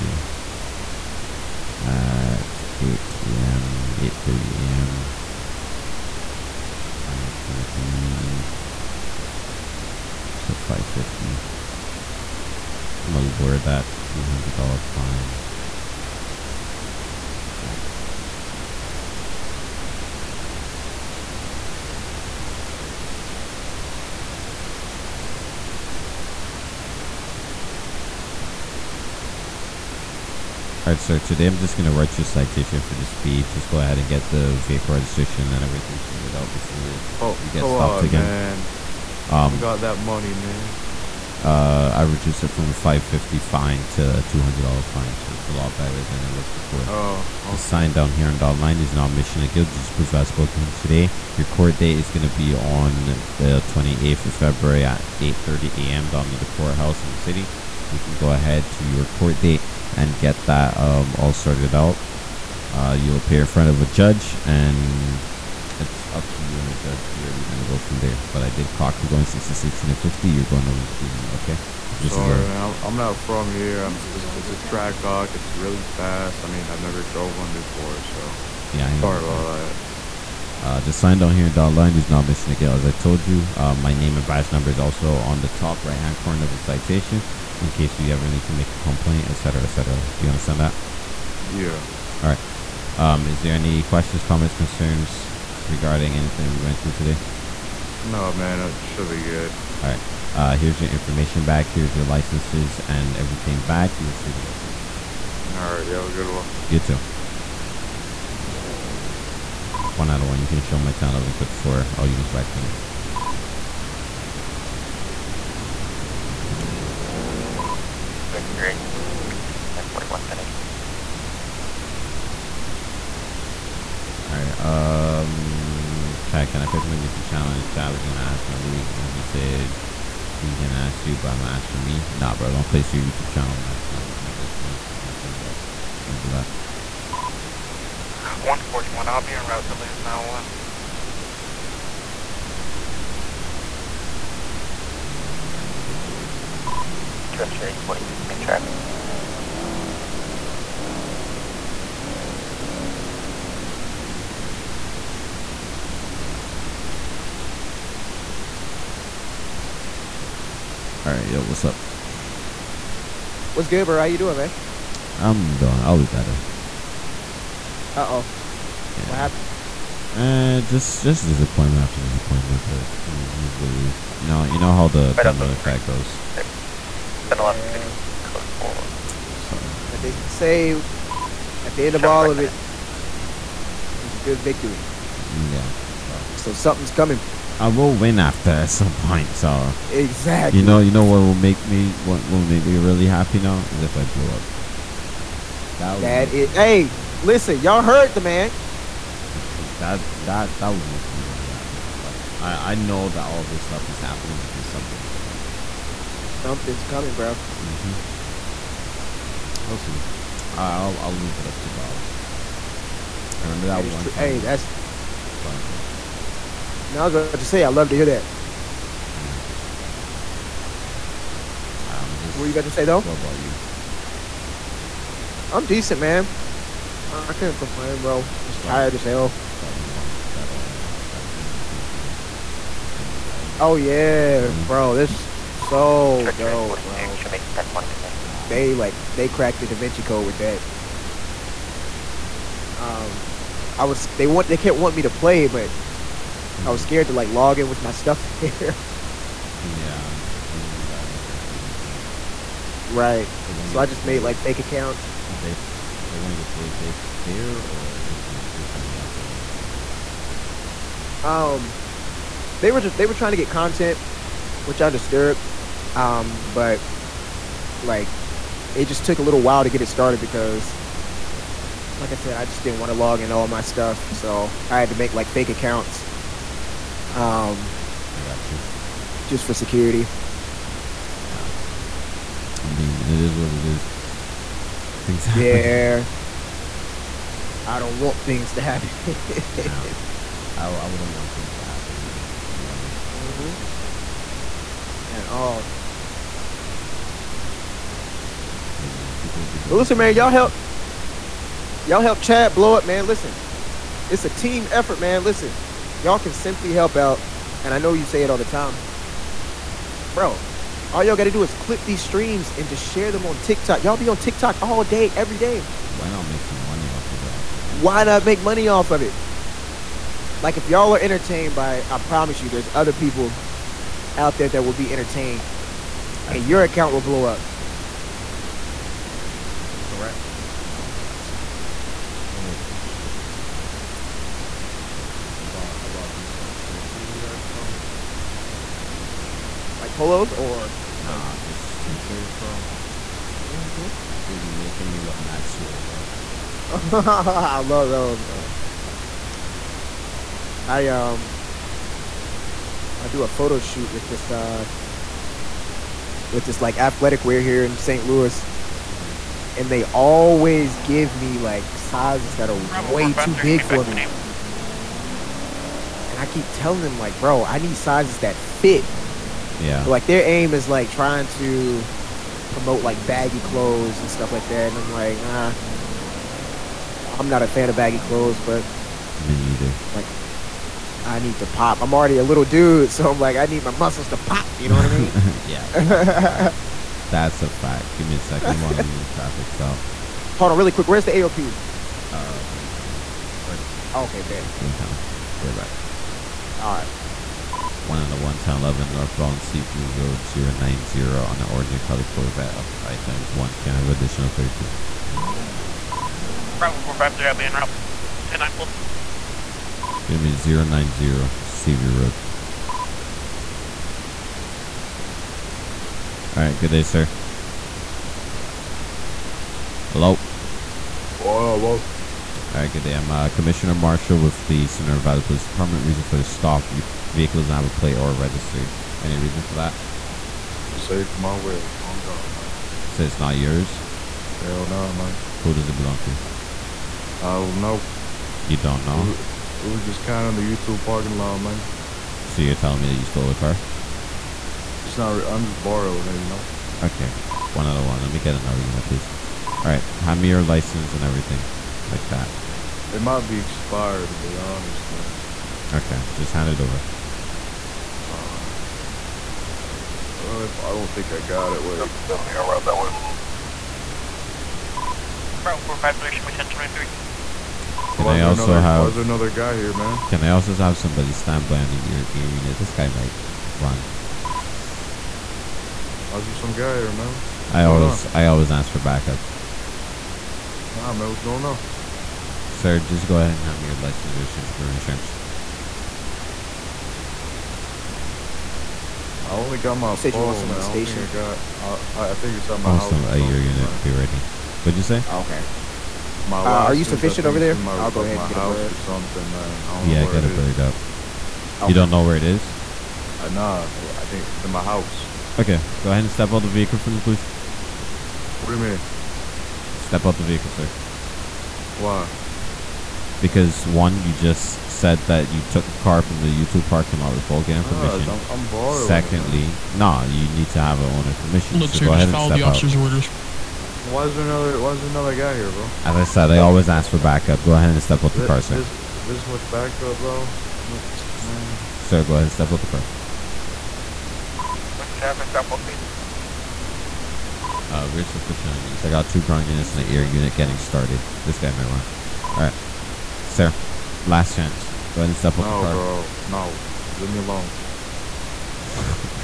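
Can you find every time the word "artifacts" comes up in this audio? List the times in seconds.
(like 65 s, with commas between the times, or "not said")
not said.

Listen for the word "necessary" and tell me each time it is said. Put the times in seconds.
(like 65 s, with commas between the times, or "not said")
not said.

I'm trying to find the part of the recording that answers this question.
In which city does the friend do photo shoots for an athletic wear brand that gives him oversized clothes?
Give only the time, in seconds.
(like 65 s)
357 s.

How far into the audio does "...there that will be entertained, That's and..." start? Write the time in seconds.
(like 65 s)
324 s.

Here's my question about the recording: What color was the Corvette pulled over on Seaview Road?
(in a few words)
Orange.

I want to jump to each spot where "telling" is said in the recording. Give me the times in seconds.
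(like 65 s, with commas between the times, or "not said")
366 s, 442 s.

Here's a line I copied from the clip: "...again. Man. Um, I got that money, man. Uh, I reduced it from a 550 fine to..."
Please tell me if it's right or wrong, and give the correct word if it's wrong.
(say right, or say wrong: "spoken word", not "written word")
right.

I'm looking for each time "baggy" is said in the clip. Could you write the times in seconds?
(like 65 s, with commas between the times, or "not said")
373 s, 377 s.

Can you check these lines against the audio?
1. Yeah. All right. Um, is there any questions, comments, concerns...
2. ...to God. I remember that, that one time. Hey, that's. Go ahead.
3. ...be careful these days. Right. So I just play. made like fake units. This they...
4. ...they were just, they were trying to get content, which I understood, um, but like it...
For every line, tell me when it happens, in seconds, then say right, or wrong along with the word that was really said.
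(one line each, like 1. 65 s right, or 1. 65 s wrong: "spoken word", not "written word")
1. 91 s right
2. 211 s right
3. 251 s wrong: "accounts", not "units"
4. 262 s right.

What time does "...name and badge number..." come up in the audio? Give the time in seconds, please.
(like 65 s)
83 s.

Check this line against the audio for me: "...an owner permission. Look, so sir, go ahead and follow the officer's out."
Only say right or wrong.
right.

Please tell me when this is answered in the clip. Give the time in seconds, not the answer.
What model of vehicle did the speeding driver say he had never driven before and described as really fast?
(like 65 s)
74 s.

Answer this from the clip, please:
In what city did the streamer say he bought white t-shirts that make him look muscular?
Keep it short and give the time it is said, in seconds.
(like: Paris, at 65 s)
New York, at 337 s.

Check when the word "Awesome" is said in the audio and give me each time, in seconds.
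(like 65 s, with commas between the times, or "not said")
492 s.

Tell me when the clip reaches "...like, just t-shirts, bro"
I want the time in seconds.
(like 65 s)
341 s.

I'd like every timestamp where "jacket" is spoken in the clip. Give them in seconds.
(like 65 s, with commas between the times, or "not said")
not said.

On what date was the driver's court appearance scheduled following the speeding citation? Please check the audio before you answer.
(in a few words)
28th of February.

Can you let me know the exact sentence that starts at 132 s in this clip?
Nah, bro, don't place your YouTube channel my my my this, my, my thing, bro.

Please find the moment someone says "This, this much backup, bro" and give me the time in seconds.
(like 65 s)
528 s.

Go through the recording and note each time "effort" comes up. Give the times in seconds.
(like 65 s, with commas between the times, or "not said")
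304 s.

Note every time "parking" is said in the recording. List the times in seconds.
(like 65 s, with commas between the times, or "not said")
440 s, 516 s.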